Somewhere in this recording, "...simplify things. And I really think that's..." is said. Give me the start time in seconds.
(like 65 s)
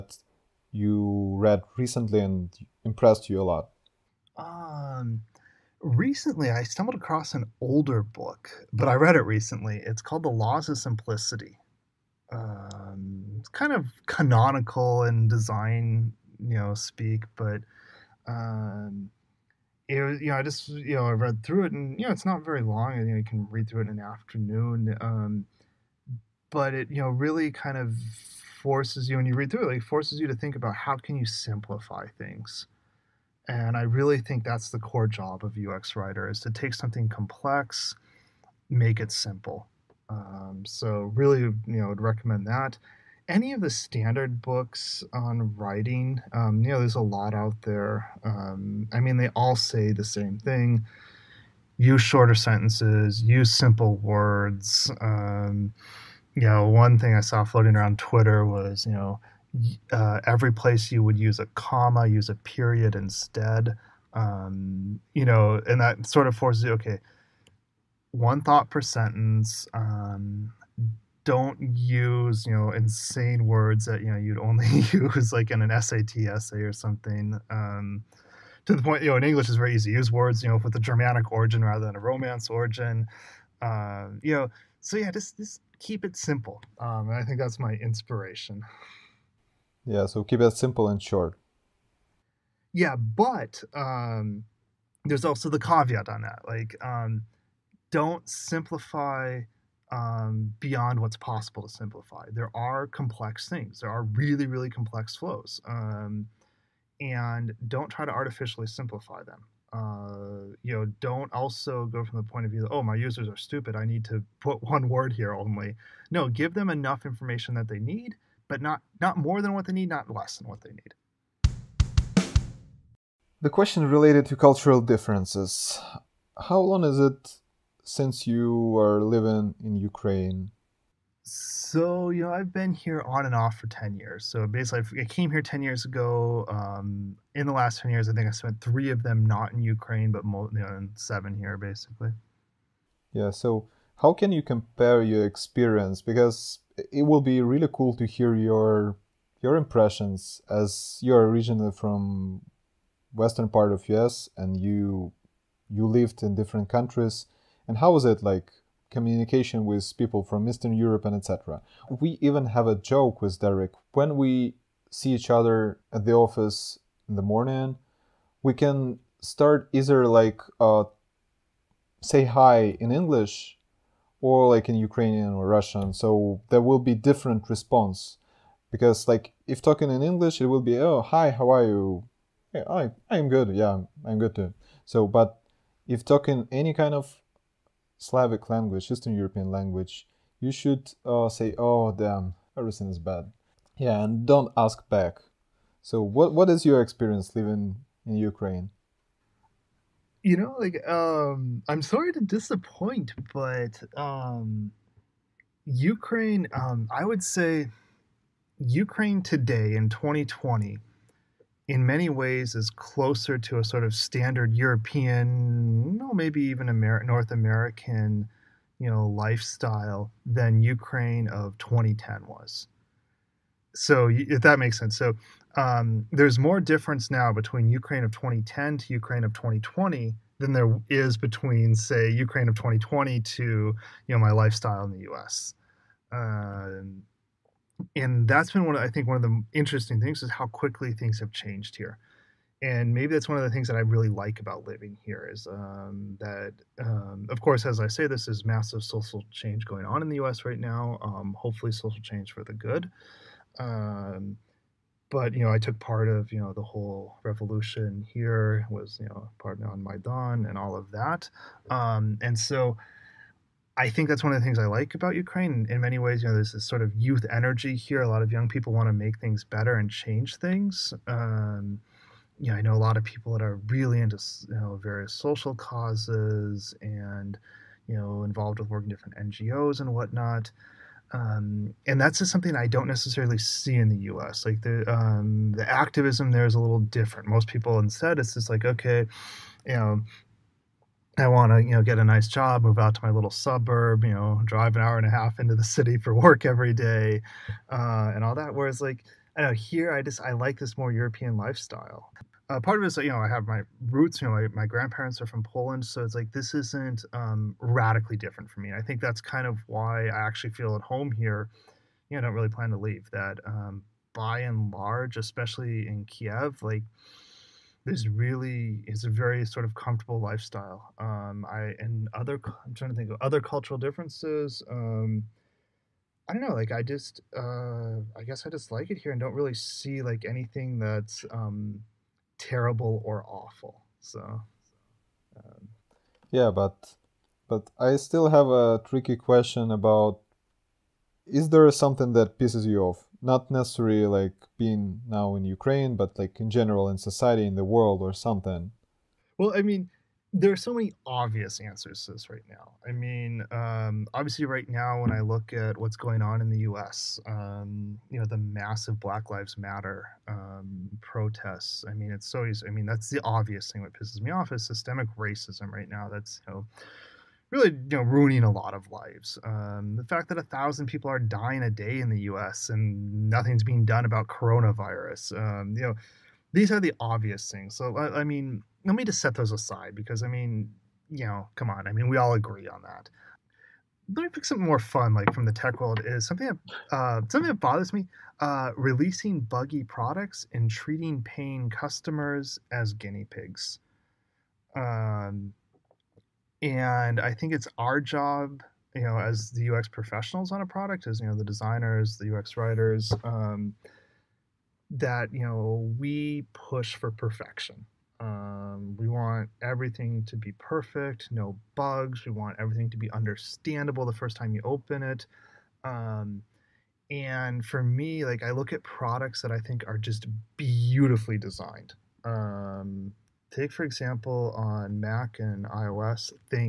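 31 s.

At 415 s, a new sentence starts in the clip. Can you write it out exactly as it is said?
Um, and for me, like I look at products that I think are just beautifully designed.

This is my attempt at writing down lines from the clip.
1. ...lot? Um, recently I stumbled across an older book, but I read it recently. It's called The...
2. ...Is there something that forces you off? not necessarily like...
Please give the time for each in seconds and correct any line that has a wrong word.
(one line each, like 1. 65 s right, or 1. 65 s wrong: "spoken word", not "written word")
1. 3 s right
2. 341 s wrong: "pisses", not "forces".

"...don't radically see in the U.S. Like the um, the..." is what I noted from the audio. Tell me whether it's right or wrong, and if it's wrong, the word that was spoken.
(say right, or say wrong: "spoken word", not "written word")
wrong: "necessarily", not "radically".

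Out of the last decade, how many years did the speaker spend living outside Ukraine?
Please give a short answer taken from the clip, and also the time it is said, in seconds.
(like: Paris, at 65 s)
3, at 138 s.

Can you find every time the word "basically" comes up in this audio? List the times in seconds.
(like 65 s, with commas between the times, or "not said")
134 s, 141 s.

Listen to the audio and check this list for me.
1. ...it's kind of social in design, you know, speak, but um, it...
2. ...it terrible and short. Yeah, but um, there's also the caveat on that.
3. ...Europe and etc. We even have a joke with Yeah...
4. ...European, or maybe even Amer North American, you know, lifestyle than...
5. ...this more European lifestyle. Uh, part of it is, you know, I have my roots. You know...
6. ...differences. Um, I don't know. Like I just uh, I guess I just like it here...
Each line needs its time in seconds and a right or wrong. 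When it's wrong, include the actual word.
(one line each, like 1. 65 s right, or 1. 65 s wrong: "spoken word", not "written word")
1. 13 s wrong: "canonical", not "social"
2. 90 s wrong: "simple", not "terrible"
3. 160 s wrong: "Derek", not "Yeah"
4. 214 s right
5. 300 s right
6. 323 s right.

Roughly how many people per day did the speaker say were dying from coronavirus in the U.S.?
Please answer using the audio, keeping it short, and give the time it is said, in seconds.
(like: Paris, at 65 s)
1000, at 370 s.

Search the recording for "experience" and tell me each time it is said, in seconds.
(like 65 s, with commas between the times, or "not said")
145 s, 196 s.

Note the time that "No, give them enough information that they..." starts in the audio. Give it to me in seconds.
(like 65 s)
116 s.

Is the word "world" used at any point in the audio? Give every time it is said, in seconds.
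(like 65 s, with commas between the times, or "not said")
347 s, 385 s.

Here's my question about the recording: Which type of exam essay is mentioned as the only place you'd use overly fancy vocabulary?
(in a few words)
SAT.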